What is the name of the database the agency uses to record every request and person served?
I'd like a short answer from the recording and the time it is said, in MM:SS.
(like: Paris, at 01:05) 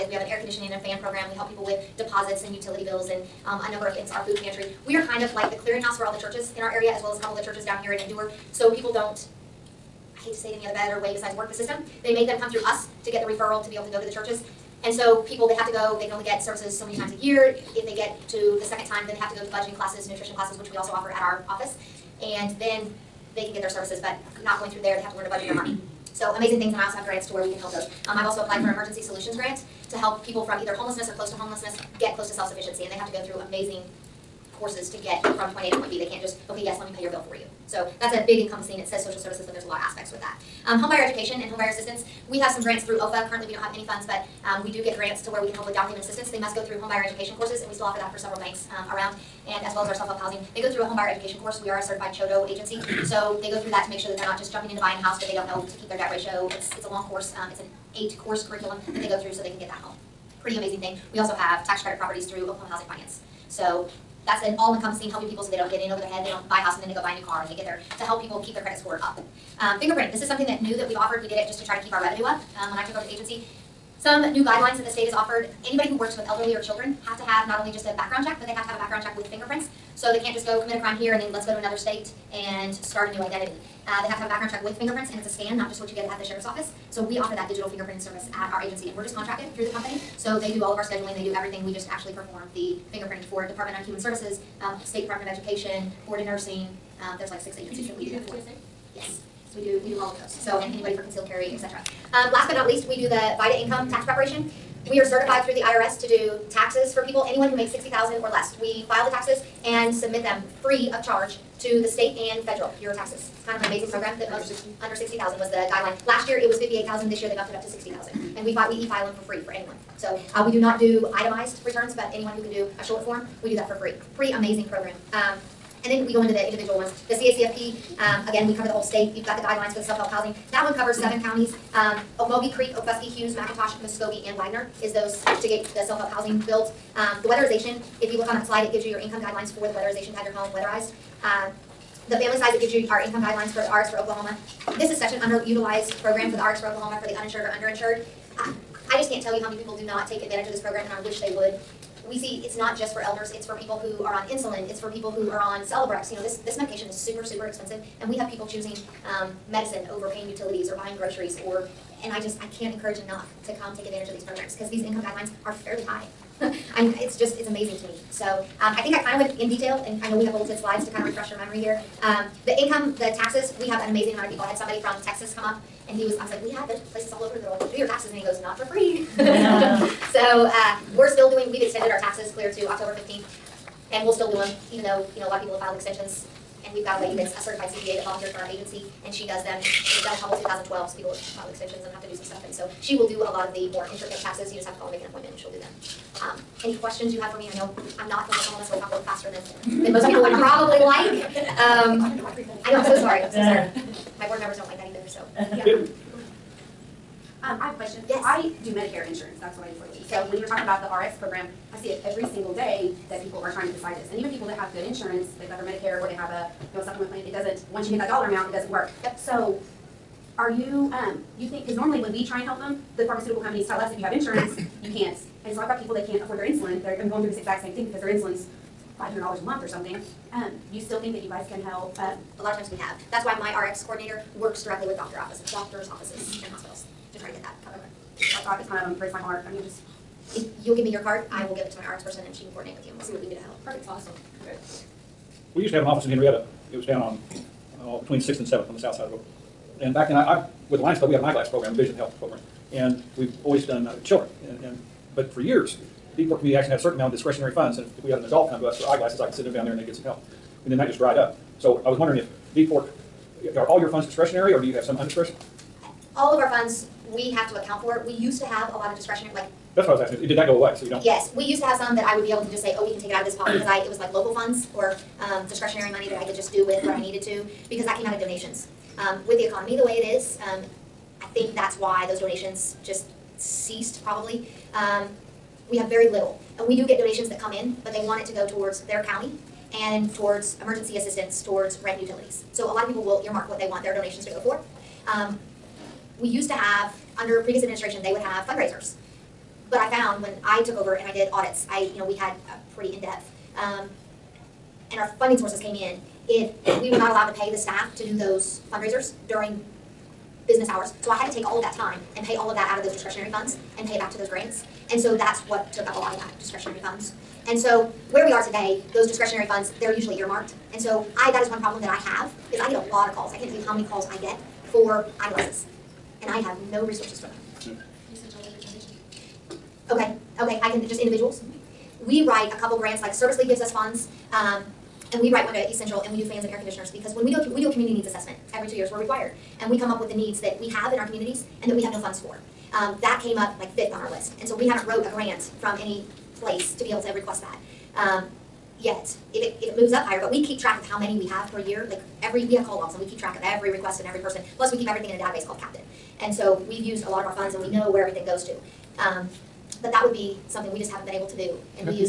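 Captain, at 05:55.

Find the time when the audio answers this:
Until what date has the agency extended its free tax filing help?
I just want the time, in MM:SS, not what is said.
03:02.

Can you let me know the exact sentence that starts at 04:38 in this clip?
Um, With the economy the way it is, um, I think that's why those donations just ceased probably.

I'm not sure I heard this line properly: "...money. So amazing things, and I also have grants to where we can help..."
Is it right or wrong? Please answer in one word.
right.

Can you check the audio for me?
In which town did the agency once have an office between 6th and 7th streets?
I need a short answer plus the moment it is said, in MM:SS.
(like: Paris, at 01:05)
Henryetta, at 04:06.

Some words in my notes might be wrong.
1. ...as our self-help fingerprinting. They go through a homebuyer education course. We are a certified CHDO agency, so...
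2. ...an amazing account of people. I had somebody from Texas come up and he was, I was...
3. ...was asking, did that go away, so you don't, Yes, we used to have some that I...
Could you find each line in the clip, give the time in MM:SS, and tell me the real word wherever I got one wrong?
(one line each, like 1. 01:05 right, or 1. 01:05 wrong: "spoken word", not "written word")
1. 00:49 wrong: "housing", not "fingerprinting"
2. 02:53 wrong: "amount", not "account"
3. 04:29 right.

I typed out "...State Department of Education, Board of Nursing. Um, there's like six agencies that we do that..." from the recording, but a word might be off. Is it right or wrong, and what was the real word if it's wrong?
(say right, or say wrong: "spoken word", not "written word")
right.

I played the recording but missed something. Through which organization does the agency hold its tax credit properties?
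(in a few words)
Oklahoma Housing Finance.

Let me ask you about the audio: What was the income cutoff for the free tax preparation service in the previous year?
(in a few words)
58,000.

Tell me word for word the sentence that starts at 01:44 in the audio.
We are certified through the IRS to do taxes for people, anyone who makes 60000 or less.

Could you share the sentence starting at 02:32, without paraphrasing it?
We see it's not just for elders, it's for people who are on insulin, it's for people who are on Celebrex.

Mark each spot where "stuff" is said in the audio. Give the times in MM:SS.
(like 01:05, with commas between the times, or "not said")
03:12.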